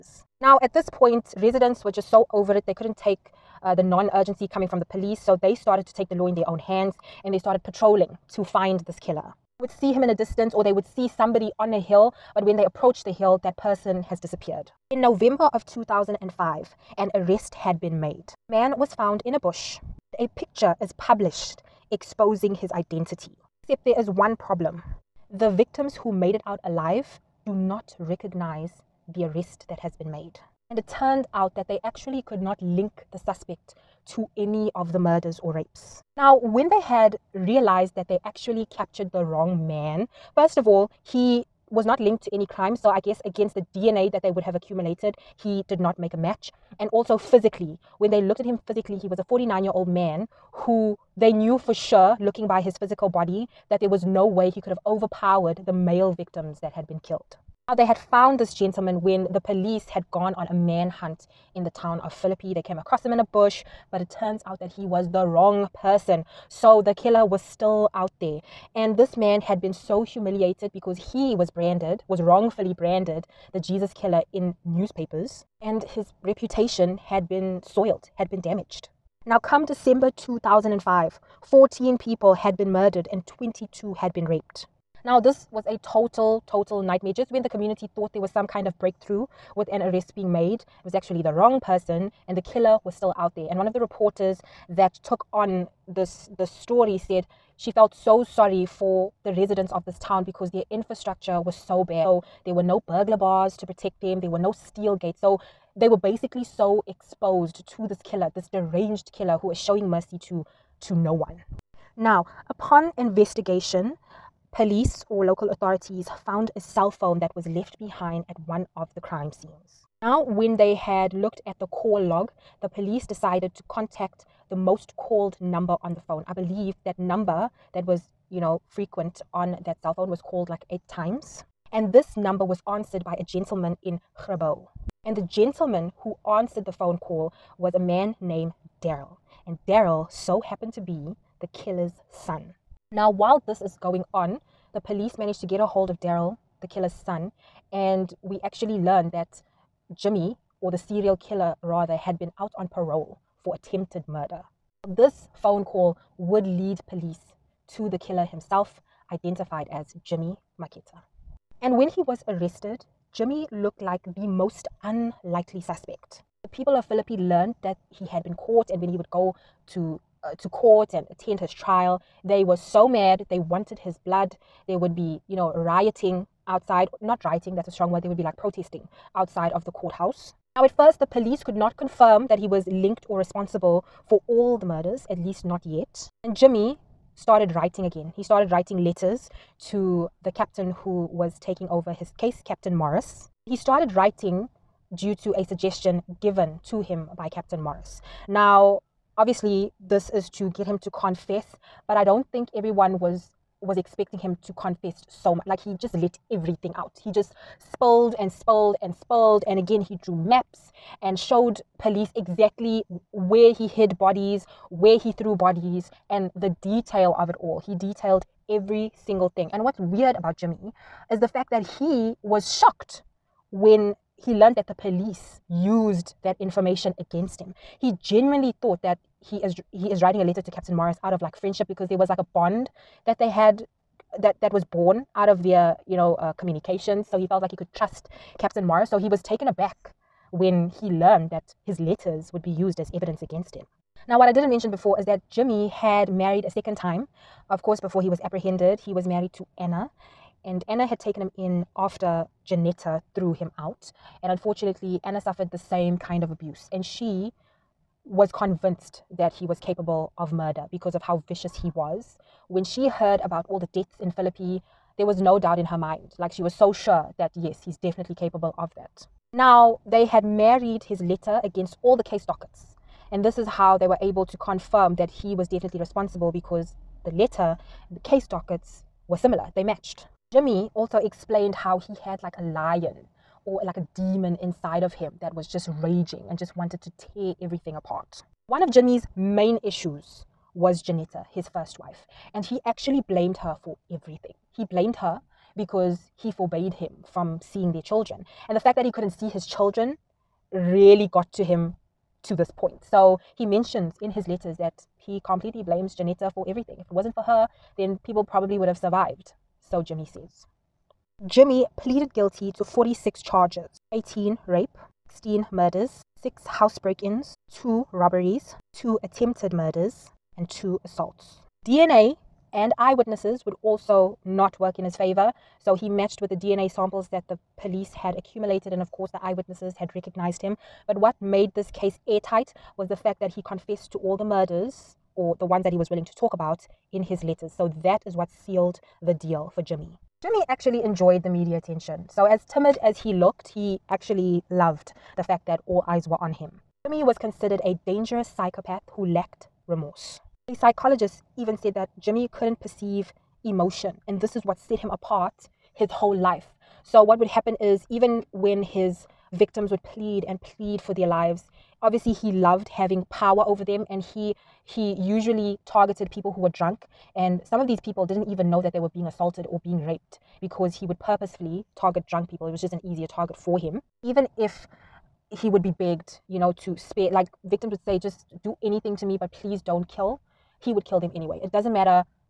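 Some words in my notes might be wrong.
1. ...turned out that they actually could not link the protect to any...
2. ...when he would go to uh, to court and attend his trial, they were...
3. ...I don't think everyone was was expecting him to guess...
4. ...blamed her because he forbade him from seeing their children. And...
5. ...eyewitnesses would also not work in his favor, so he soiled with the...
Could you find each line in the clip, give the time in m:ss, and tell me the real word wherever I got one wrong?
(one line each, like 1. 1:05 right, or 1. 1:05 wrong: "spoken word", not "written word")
1. 0:30 wrong: "suspect", not "protect"
2. 2:48 right
3. 3:21 wrong: "confess", not "guess"
4. 4:54 right
5. 5:22 wrong: "matched", not "soiled".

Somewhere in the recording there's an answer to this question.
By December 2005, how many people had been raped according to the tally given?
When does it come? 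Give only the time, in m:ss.
1:23.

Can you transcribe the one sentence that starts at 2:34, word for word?
This phone call would lead police to the killer himself, identified as Jimmy Maketta.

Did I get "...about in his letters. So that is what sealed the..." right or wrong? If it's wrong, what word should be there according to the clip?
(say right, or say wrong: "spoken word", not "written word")
right.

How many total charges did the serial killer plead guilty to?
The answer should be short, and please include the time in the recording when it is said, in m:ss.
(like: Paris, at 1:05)
46, at 5:12.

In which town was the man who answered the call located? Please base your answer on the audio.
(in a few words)
Grabouw.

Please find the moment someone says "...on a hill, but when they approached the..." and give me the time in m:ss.
0:11.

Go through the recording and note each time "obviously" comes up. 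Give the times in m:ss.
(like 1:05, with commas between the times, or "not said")
3:19, 6:01.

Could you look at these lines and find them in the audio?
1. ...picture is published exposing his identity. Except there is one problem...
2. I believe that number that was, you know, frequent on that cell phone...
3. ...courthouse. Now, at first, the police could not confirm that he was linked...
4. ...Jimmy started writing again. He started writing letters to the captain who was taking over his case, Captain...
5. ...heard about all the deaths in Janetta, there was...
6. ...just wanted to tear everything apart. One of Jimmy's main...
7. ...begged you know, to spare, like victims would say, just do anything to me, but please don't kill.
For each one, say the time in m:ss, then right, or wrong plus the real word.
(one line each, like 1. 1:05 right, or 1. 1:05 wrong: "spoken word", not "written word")
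1. 0:20 right
2. 2:06 right
3. 2:59 right
4. 3:06 right
5. 4:22 wrong: "Philippi", not "Janetta"
6. 4:46 right
7. 6:15 right.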